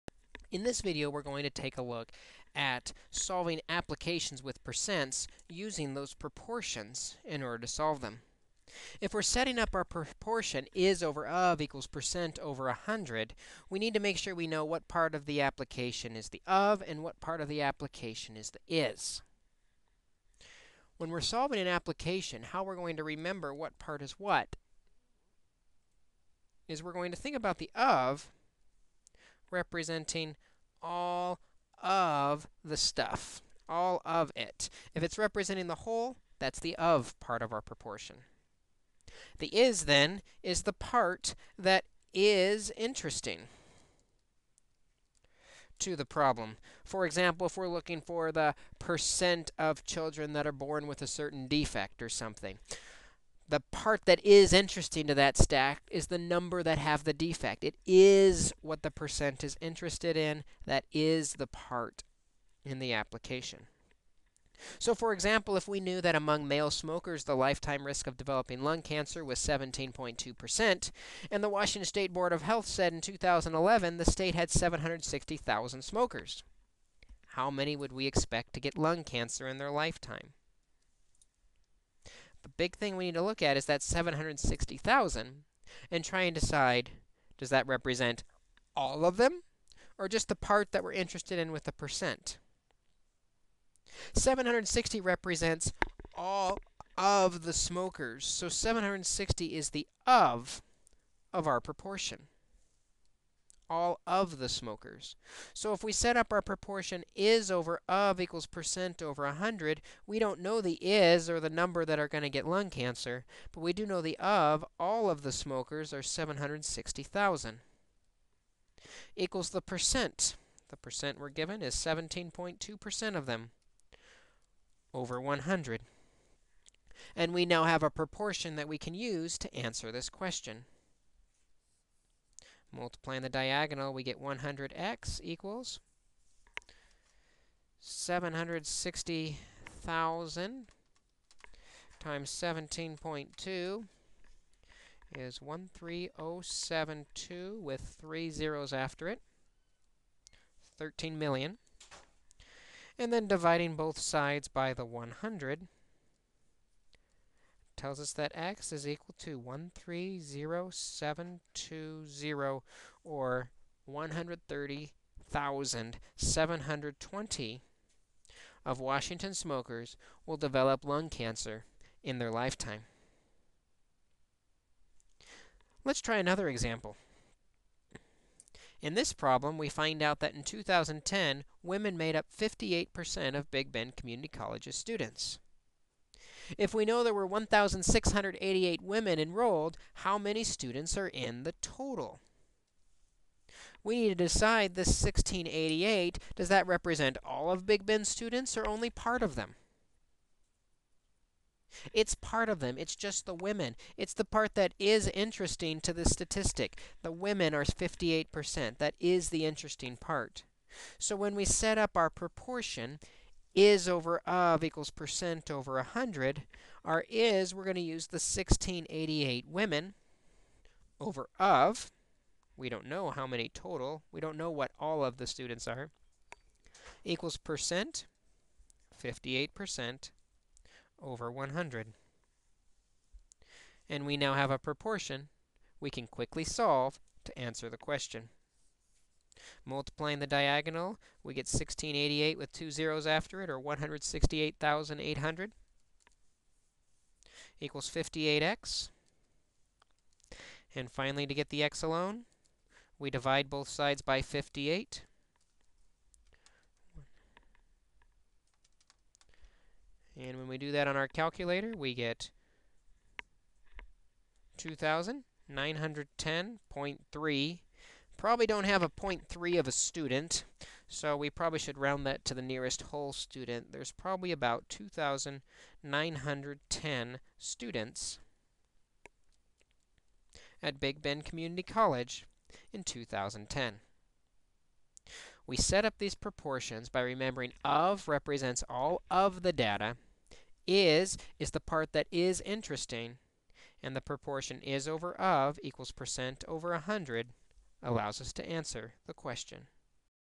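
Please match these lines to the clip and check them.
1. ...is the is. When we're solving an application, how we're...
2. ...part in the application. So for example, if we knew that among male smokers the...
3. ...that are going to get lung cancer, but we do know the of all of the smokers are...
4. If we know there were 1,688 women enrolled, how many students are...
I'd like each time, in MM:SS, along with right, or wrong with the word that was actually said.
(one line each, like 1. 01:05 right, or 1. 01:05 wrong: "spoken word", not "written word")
1. 00:18 right
2. 01:01 right
3. 01:51 right
4. 03:06 right.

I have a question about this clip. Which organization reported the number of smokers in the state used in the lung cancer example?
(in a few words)
Washington State Board of Health.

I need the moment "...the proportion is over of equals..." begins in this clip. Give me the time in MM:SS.
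04:53.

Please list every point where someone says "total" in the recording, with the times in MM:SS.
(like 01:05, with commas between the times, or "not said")
03:11, 03:43.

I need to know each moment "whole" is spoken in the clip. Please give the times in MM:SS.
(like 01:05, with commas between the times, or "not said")
00:35, 04:32.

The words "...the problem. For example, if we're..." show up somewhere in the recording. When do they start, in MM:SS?
00:45.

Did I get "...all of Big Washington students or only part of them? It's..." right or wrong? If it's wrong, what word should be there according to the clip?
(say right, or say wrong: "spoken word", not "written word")
wrong: "Bend", not "Washington".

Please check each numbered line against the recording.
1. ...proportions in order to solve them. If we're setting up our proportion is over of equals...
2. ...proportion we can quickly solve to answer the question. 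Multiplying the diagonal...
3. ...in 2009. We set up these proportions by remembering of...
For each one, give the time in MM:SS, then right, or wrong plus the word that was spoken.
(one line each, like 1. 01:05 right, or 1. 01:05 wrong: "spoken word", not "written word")
1. 00:06 right
2. 03:54 right
3. 04:42 wrong: "2010", not "2009".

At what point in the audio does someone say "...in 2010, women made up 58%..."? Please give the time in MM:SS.
03:00.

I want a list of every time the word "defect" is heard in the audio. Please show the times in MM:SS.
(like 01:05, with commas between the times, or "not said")
00:51, 00:57.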